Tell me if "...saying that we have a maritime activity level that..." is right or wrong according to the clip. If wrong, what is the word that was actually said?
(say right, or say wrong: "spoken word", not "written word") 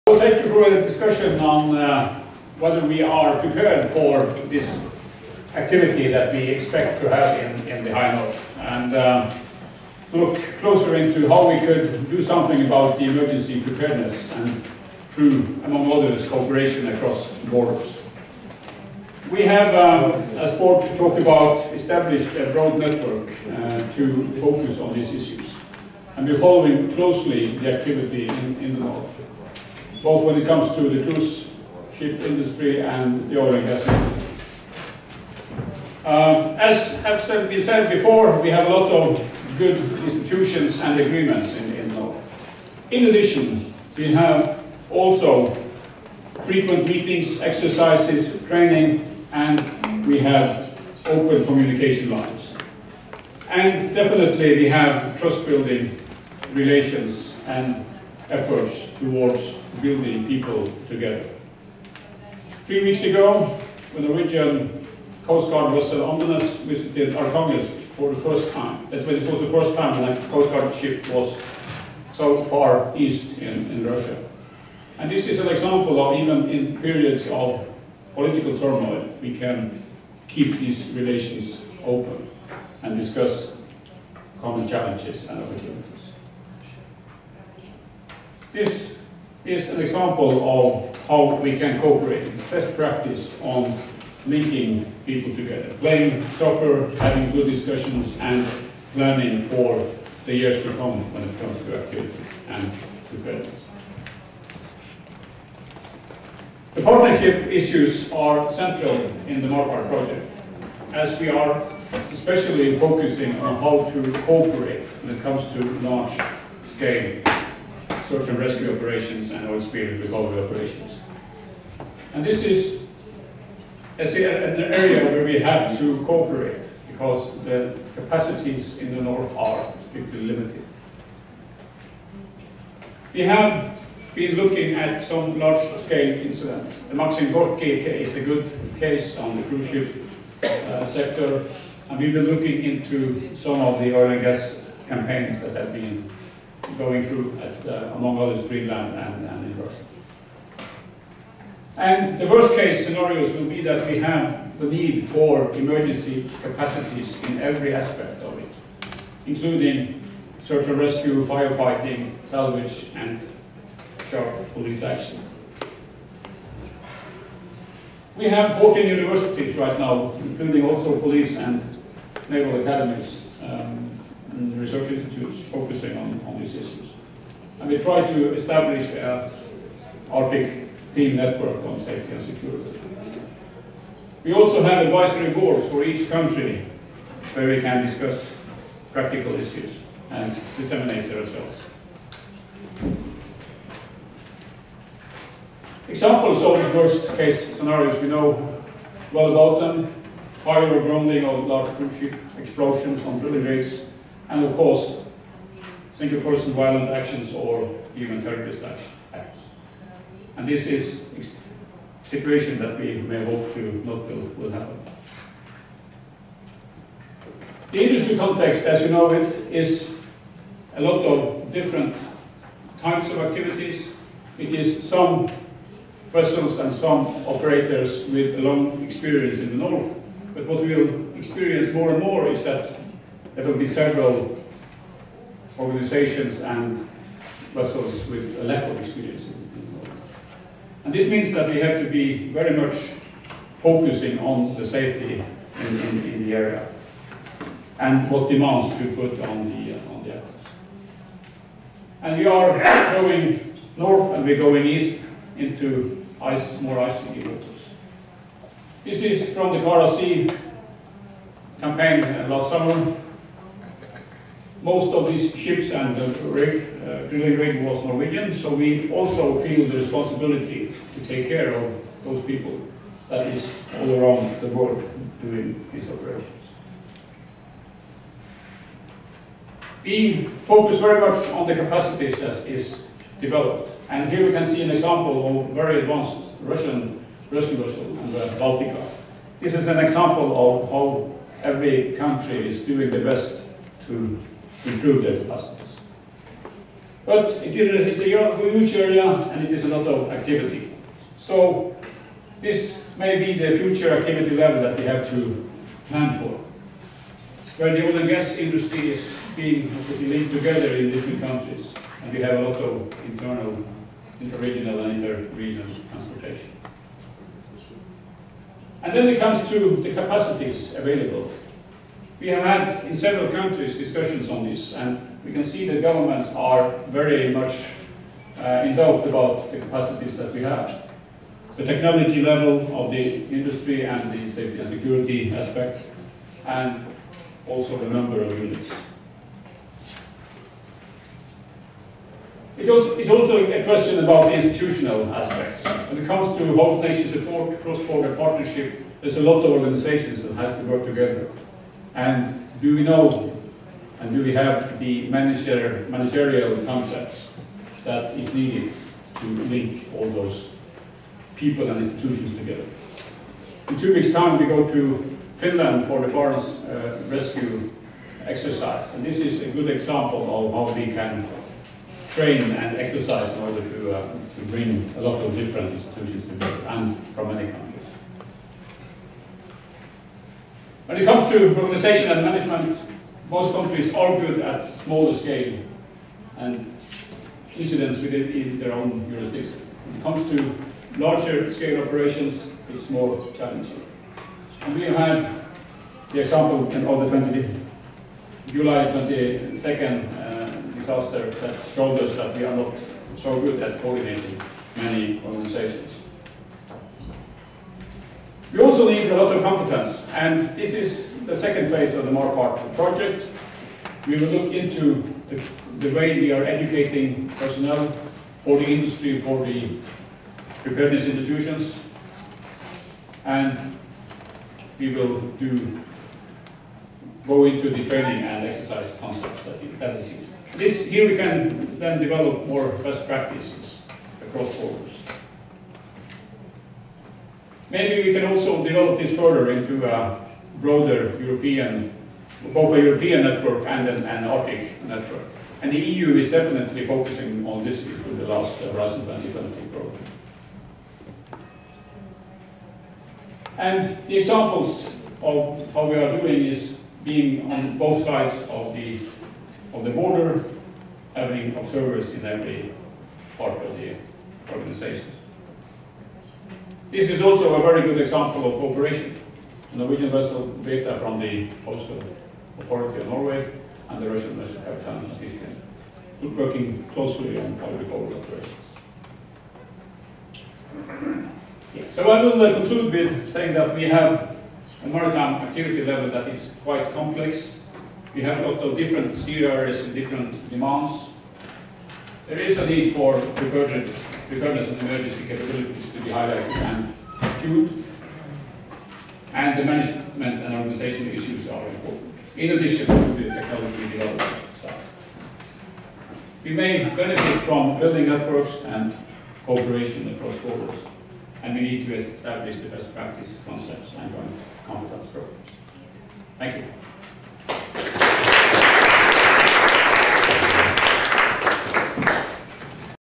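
right.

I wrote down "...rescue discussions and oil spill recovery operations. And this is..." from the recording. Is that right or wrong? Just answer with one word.
wrong.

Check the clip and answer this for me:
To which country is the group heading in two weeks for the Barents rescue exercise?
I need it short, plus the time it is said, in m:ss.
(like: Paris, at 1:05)
Finland, at 6:05.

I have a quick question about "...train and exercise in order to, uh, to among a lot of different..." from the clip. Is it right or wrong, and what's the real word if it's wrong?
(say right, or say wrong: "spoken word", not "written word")
wrong: "bring", not "among".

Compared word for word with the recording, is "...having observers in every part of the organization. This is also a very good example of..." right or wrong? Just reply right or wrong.
right.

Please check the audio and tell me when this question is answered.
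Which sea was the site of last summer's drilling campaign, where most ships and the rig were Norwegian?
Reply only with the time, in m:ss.
4:19.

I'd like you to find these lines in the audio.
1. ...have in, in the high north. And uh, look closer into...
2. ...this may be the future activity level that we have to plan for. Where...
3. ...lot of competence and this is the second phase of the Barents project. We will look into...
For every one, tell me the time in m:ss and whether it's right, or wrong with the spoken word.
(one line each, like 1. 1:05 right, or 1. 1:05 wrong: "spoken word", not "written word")
1. 0:07 right
2. 5:02 right
3. 6:49 wrong: "MARPART", not "Barents".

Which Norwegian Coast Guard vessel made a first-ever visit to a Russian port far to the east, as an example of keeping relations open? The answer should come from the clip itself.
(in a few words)
Andenes.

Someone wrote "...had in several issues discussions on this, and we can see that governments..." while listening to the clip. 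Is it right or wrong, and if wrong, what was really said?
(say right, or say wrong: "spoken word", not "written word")
wrong: "countries", not "issues".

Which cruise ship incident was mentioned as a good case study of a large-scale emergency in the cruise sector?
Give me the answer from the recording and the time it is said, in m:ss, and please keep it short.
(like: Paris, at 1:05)
Maxim Gorki, at 2:16.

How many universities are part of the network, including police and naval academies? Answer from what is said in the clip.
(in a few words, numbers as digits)
14.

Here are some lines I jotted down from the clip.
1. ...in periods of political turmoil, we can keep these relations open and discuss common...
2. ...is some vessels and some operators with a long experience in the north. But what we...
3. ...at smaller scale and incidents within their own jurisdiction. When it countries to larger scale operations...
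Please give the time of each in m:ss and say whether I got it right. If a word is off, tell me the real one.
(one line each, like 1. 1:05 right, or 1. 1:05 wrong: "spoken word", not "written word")
1. 1:16 right
2. 3:44 right
3. 6:24 wrong: "comes", not "countries".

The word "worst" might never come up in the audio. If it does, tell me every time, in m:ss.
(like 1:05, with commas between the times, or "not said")
2:32, 3:16.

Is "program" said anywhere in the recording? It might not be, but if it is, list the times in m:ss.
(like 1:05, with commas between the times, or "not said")
7:29, 8:35.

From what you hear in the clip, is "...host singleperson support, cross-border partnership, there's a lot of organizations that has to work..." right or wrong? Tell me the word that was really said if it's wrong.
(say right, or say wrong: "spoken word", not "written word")
wrong: "nation", not "singleperson".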